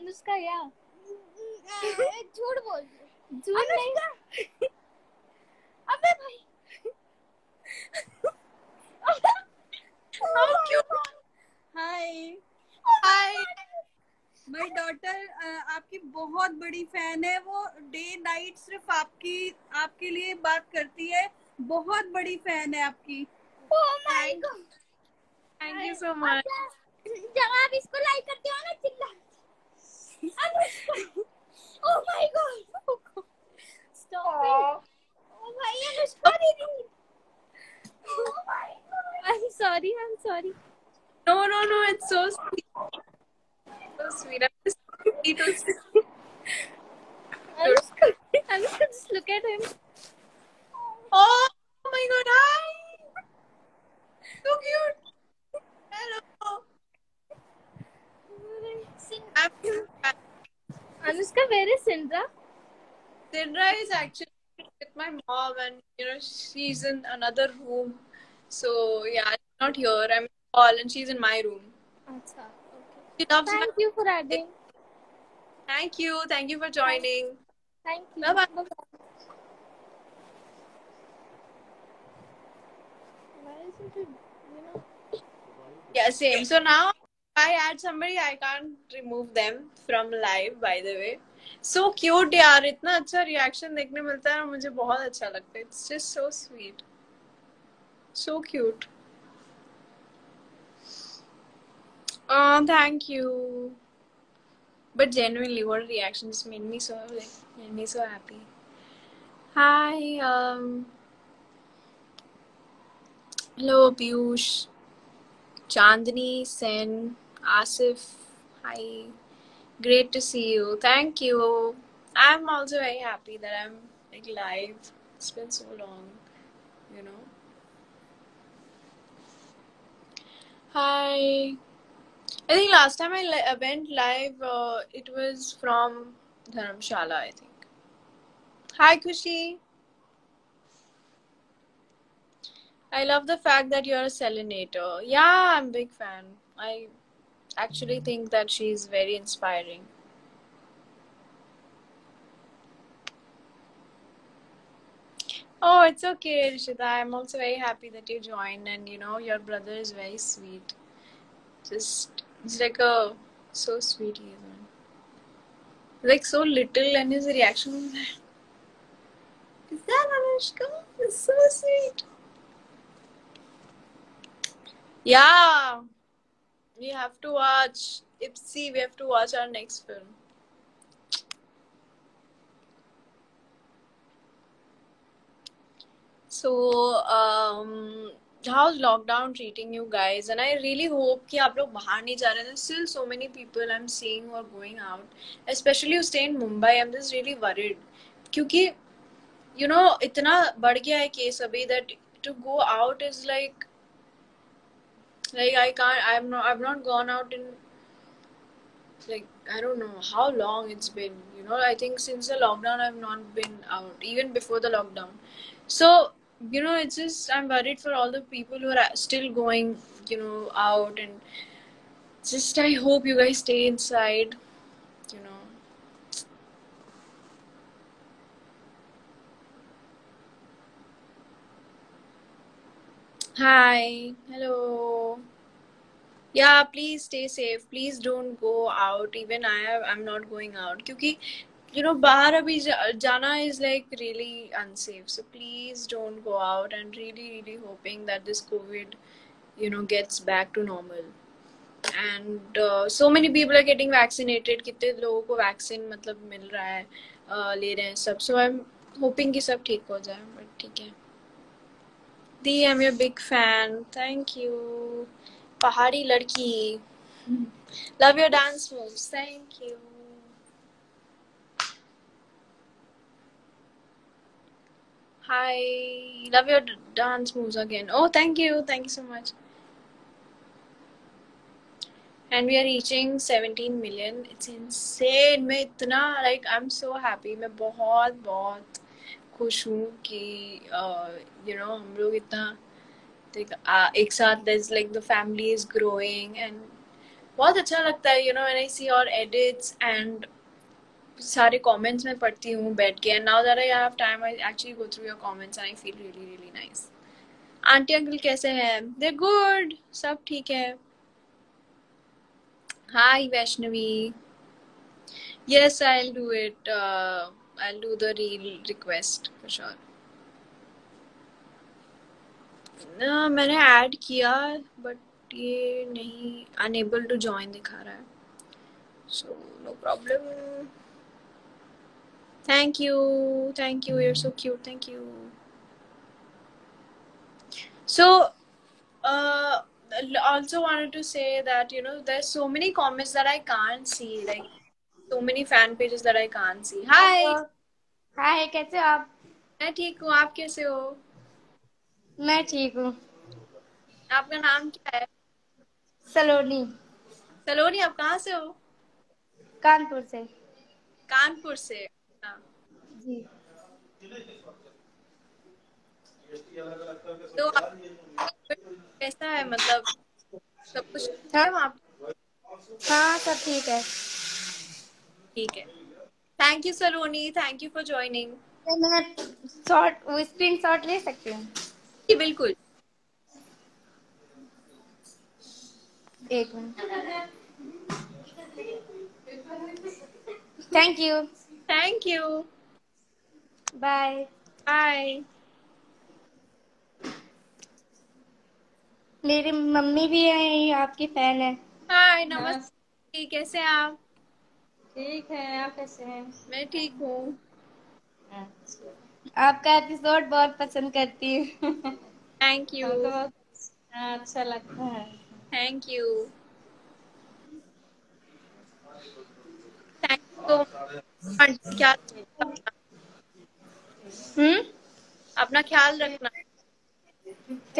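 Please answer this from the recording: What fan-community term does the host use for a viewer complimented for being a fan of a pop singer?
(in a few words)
Selenator.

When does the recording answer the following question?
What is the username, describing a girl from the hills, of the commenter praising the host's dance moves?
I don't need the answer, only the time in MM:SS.
04:25.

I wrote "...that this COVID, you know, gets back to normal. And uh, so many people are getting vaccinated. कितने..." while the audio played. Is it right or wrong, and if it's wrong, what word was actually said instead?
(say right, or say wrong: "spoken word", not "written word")
right.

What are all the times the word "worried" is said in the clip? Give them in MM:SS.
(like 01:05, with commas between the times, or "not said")
03:17, 03:37.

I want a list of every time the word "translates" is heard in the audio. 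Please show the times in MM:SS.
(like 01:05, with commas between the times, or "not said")
not said.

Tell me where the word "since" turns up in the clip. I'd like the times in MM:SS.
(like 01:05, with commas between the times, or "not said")
03:31.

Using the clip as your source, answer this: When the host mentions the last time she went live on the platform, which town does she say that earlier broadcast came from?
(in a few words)
Dharamshala.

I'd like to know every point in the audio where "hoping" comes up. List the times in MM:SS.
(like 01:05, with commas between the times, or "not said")
04:07, 04:18.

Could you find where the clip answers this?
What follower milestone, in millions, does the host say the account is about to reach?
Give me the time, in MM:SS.
04:43.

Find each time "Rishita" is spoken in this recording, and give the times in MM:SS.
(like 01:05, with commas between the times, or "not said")
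02:36.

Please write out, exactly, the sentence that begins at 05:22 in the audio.
No, I add kia but ye nahi, unable to join the car.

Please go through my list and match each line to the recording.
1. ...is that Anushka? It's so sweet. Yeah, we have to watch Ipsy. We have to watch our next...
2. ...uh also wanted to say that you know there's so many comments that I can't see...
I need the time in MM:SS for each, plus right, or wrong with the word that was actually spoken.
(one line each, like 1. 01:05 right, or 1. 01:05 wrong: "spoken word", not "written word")
1. 02:49 right
2. 05:39 right.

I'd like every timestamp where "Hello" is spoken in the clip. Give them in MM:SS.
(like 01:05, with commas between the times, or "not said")
00:55, 01:53, 03:54.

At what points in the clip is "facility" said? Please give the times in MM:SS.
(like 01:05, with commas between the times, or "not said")
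not said.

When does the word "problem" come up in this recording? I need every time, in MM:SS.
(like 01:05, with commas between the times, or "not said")
05:29.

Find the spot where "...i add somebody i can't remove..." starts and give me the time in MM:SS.
01:27.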